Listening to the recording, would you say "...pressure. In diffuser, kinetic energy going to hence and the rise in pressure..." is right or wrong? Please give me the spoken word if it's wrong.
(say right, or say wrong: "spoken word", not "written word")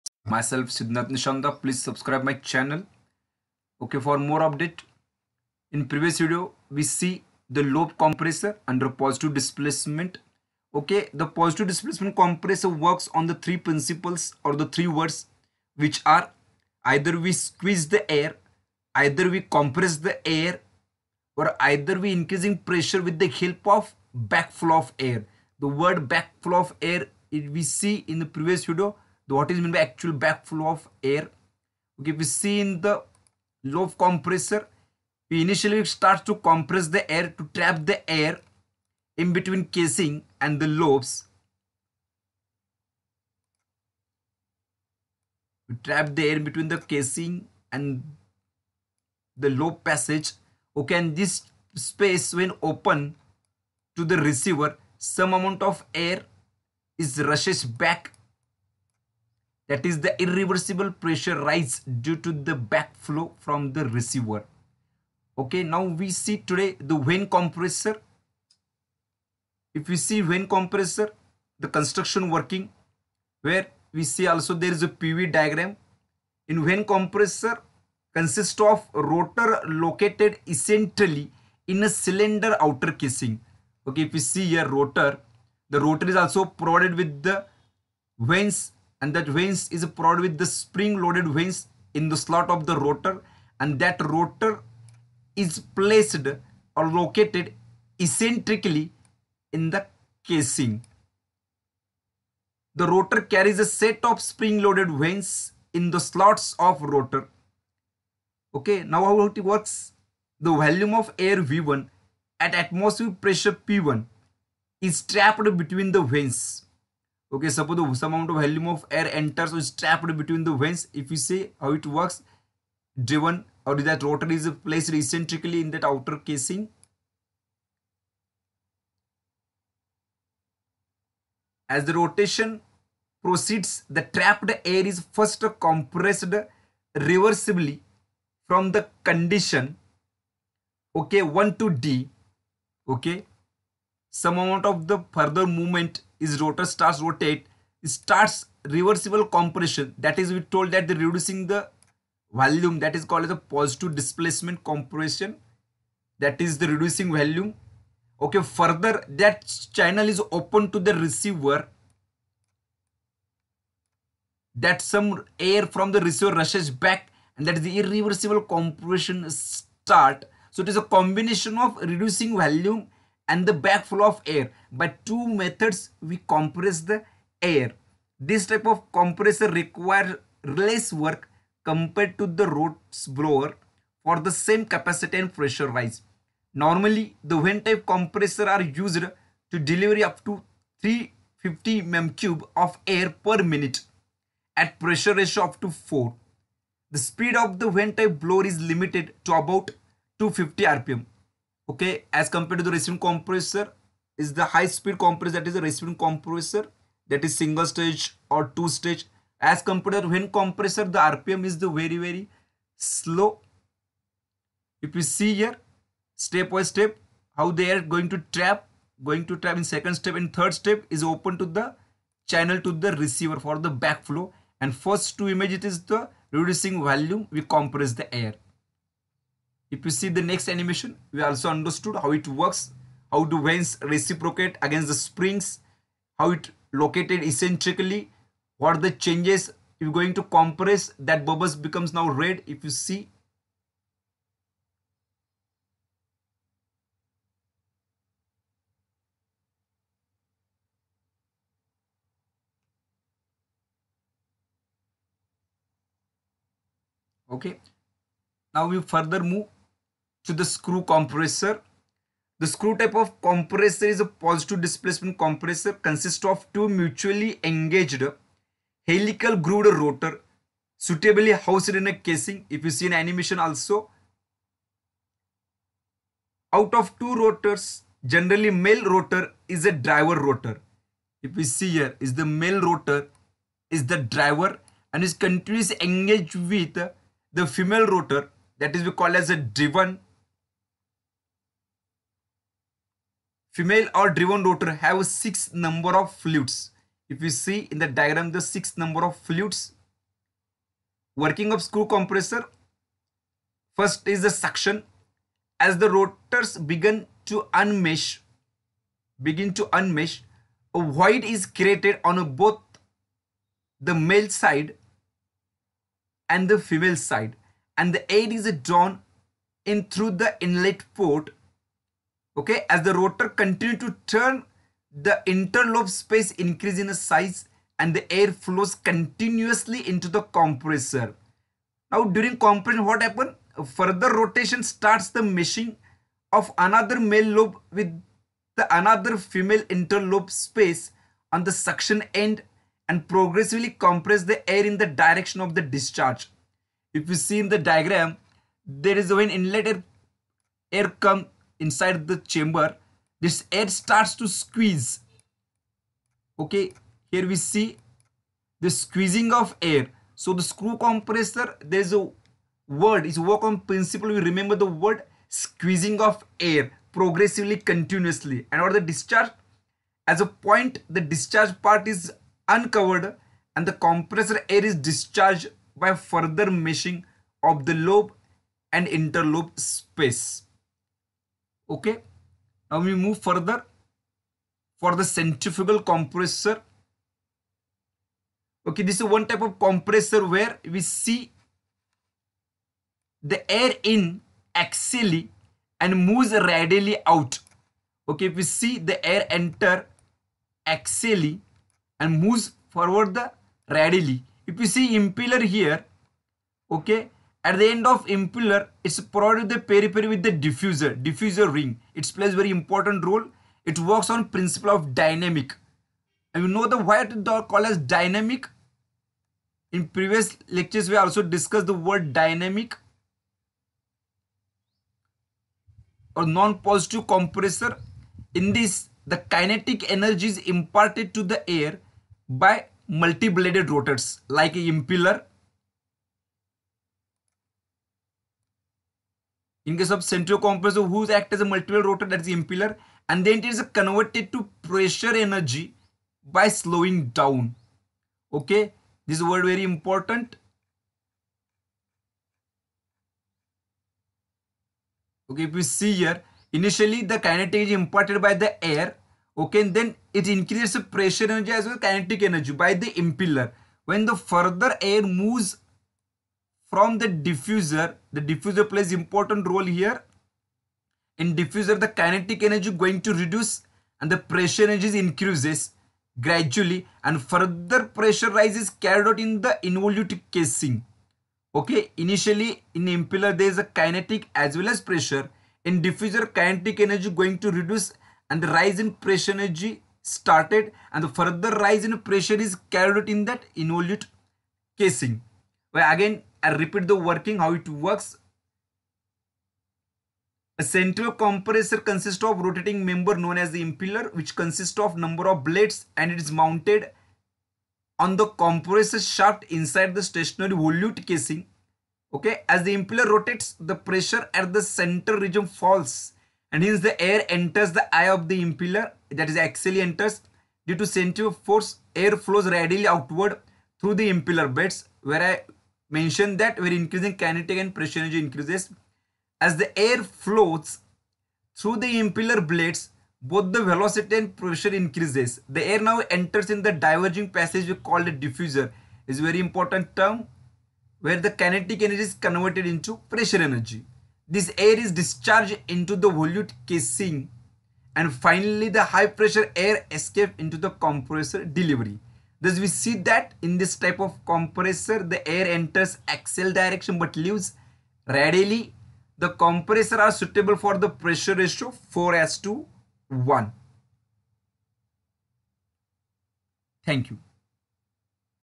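wrong: "reduce", not "hence".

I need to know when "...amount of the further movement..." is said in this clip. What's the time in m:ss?
2:24.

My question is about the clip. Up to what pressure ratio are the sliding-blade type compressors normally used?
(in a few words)
4.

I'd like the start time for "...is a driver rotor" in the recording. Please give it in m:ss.
4:39.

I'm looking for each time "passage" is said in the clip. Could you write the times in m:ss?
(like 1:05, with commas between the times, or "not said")
0:49, 8:57.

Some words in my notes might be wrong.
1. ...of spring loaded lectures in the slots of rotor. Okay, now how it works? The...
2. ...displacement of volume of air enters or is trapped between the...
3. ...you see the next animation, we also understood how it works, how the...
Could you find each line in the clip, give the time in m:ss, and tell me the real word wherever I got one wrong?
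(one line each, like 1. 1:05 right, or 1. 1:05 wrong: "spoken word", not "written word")
1. 1:44 wrong: "vanes", not "lectures"
2. 1:58 wrong: "amount", not "displacement"
3. 3:49 right.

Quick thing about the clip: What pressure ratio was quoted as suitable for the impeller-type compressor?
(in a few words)
4 to 1.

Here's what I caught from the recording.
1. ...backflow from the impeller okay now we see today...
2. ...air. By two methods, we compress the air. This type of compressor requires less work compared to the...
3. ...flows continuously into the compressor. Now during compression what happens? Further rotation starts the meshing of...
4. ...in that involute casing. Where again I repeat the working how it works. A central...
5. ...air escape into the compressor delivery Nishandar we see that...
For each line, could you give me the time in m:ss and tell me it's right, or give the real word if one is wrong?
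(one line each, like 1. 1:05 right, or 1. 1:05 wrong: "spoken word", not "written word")
1. 1:02 wrong: "receiver", not "impeller"
2. 2:54 right
3. 5:28 right
4. 8:13 right
5. 9:09 wrong: "Thus", not "Nishandar".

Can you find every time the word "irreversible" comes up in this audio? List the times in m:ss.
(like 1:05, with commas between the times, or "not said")
1:00, 2:47.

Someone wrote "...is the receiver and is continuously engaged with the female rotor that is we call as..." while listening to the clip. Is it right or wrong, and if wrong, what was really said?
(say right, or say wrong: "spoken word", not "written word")
wrong: "driver", not "receiver".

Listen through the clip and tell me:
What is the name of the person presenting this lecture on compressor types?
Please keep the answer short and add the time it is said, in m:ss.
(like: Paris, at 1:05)
Siddhant Nishandar, at 0:00.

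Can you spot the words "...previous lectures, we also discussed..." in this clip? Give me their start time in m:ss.
6:59.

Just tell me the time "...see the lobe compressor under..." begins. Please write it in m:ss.
0:06.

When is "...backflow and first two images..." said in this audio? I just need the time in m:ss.
3:43.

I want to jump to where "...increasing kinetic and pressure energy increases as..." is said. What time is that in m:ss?
8:46.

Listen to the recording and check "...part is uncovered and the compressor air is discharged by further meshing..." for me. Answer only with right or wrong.
right.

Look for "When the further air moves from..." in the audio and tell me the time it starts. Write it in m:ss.
7:43.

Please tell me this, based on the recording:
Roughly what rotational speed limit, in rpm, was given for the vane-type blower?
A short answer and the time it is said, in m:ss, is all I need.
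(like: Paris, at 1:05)
250 rpm, at 3:20.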